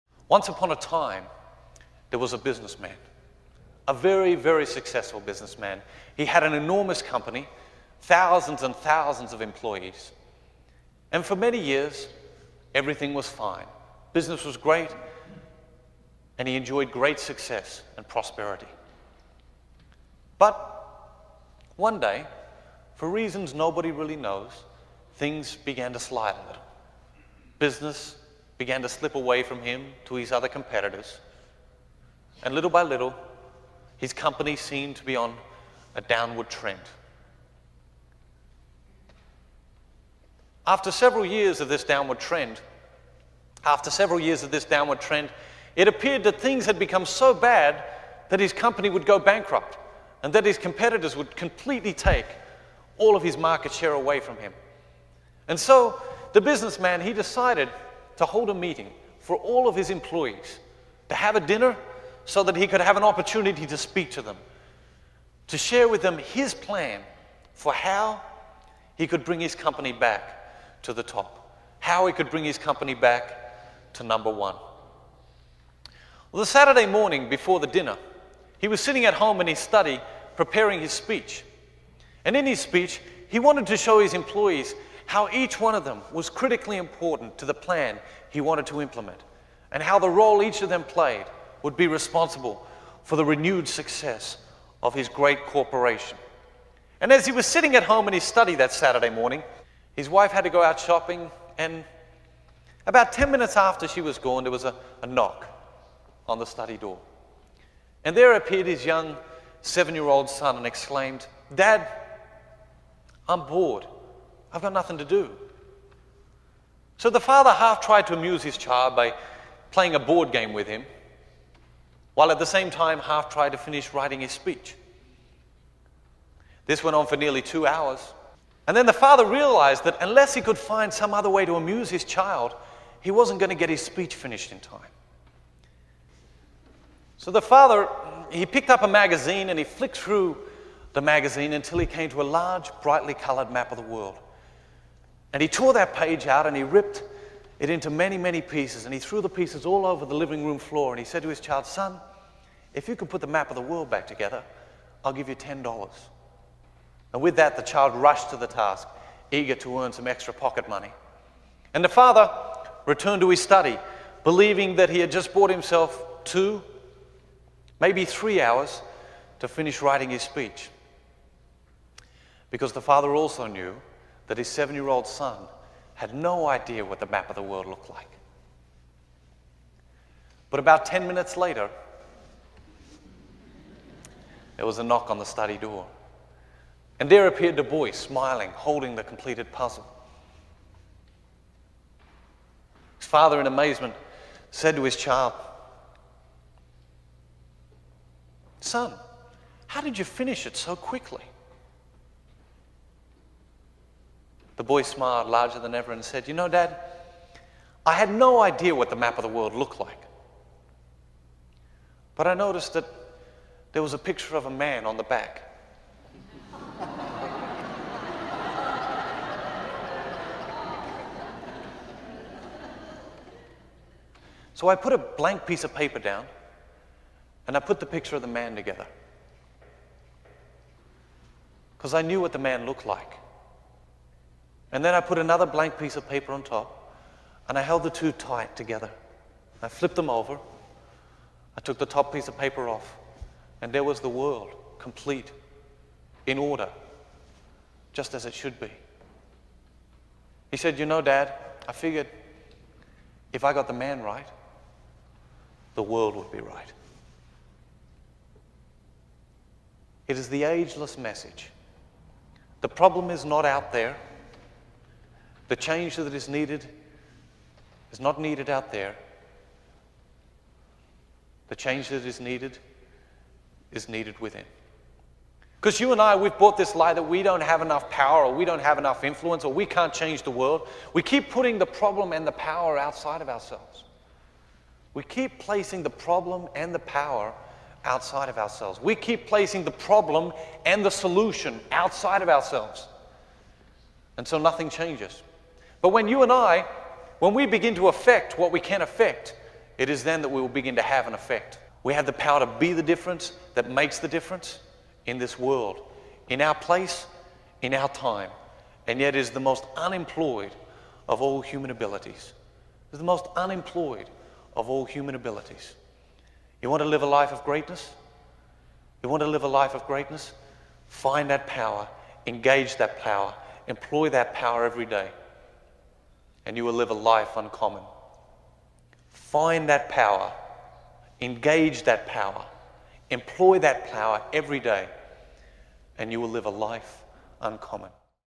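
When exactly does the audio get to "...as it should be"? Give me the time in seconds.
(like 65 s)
248 s.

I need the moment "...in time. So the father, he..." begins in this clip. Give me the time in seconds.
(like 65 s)
134 s.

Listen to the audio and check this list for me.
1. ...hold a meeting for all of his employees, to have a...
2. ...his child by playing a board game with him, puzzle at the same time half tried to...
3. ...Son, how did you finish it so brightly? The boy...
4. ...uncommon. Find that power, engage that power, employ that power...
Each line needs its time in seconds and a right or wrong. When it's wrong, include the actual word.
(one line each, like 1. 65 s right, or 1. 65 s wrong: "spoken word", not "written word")
1. 58 s right
2. 118 s wrong: "while", not "puzzle"
3. 198 s wrong: "quickly", not "brightly"
4. 327 s right.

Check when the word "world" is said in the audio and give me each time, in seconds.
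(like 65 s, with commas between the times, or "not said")
143 s, 153 s, 177 s, 209 s, 244 s, 255 s, 280 s, 305 s.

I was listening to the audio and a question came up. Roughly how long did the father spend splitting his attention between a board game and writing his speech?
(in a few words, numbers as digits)
Nearly two hours.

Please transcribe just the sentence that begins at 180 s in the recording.
But about 10 minutes later, there was a knock on the study door.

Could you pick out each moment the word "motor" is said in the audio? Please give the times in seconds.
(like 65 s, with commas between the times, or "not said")
not said.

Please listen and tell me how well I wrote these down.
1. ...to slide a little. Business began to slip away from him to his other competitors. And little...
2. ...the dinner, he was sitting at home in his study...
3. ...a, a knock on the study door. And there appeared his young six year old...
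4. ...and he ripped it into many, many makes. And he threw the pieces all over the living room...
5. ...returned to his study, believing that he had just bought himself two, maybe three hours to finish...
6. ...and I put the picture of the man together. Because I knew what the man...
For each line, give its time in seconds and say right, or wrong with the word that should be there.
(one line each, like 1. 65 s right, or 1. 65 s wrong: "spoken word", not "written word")
1. 25 s right
2. 77 s right
3. 104 s wrong: "seven", not "six"
4. 146 s wrong: "pieces", not "makes"
5. 162 s right
6. 227 s right.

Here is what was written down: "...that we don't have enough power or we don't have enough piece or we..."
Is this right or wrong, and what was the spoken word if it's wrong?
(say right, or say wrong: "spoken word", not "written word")
wrong: "influence", not "piece".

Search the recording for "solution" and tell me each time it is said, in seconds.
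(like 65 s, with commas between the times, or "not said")
290 s.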